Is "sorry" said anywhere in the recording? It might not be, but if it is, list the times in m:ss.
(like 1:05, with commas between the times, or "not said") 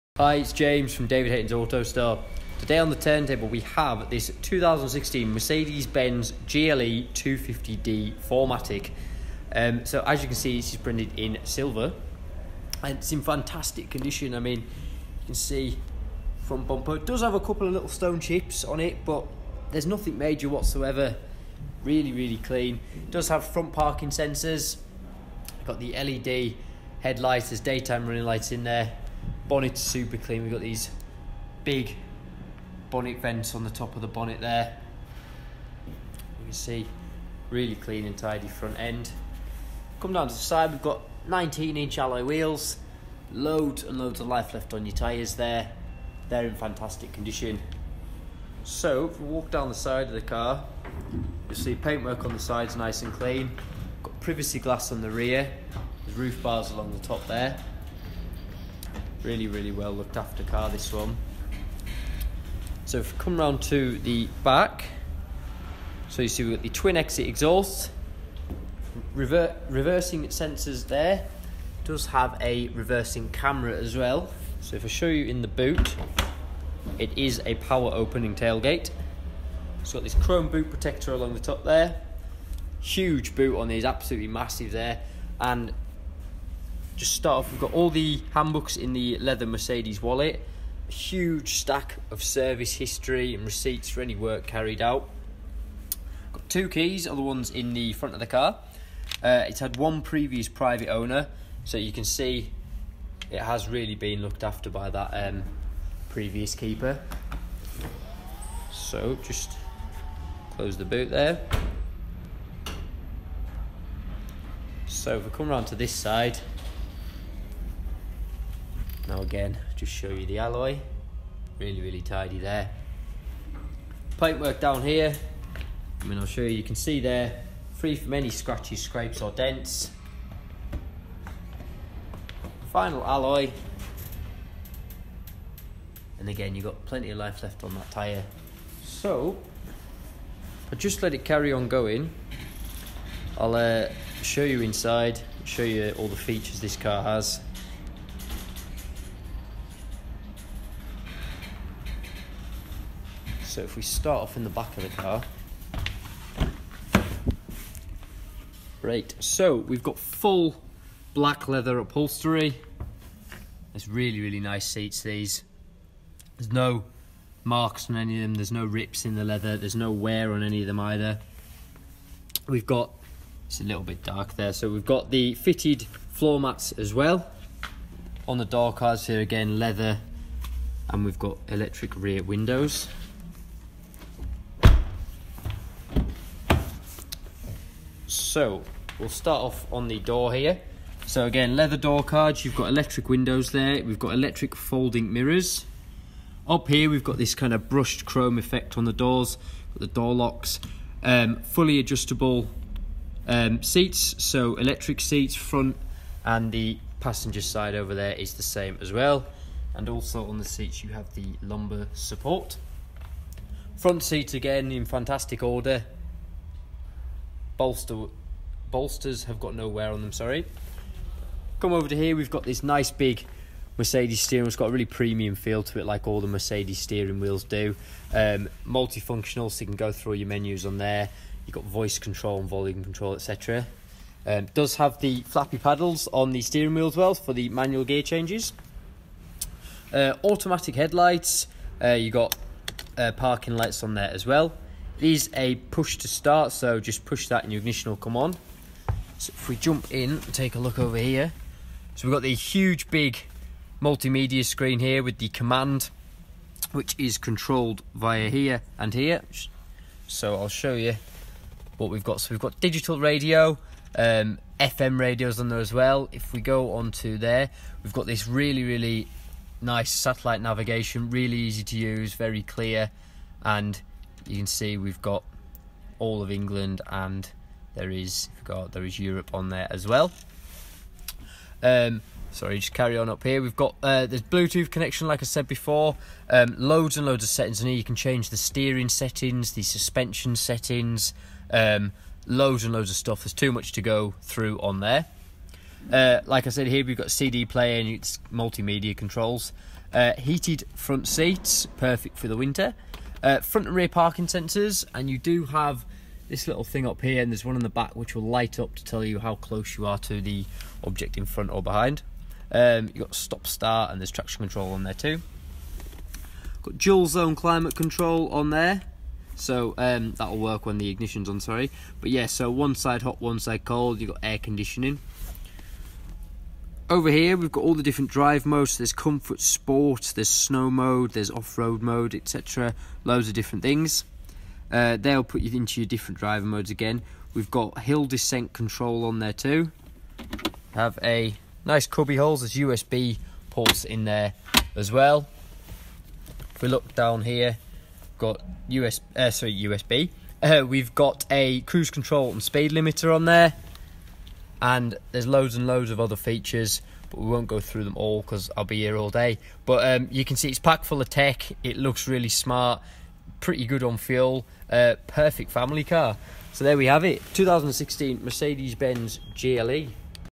3:40, 4:42, 5:21, 5:49.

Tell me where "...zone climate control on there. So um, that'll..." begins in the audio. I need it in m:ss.
5:17.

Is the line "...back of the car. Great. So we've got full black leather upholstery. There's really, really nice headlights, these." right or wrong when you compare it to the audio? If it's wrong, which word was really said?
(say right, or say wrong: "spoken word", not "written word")
wrong: "seats", not "headlights".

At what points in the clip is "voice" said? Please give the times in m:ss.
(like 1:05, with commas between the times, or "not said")
3:51.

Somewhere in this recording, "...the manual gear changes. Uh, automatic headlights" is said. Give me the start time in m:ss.
3:57.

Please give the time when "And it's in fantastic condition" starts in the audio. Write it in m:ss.
0:12.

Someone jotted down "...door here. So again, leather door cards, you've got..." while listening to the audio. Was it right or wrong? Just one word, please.
right.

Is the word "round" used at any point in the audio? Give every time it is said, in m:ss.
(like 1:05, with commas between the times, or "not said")
1:03, 1:55.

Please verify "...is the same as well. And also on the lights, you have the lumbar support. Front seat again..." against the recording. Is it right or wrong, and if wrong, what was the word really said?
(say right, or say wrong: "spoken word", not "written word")
wrong: "seats", not "lights".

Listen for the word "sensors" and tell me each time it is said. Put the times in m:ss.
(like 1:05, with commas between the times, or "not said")
0:24, 1:10, 5:04.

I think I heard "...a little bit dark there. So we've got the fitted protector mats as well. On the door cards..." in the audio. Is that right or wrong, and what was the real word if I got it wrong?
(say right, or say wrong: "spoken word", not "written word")
wrong: "floor", not "protector".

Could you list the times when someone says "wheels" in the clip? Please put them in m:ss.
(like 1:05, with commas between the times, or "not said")
0:42, 3:47, 3:56.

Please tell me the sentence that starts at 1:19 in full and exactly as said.
It's got this chrome boot protector along the top there.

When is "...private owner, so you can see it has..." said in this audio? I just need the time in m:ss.
1:40.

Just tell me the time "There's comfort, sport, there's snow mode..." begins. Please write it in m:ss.
5:28.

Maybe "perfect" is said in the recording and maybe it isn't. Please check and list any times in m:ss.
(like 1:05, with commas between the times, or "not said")
5:01, 6:05.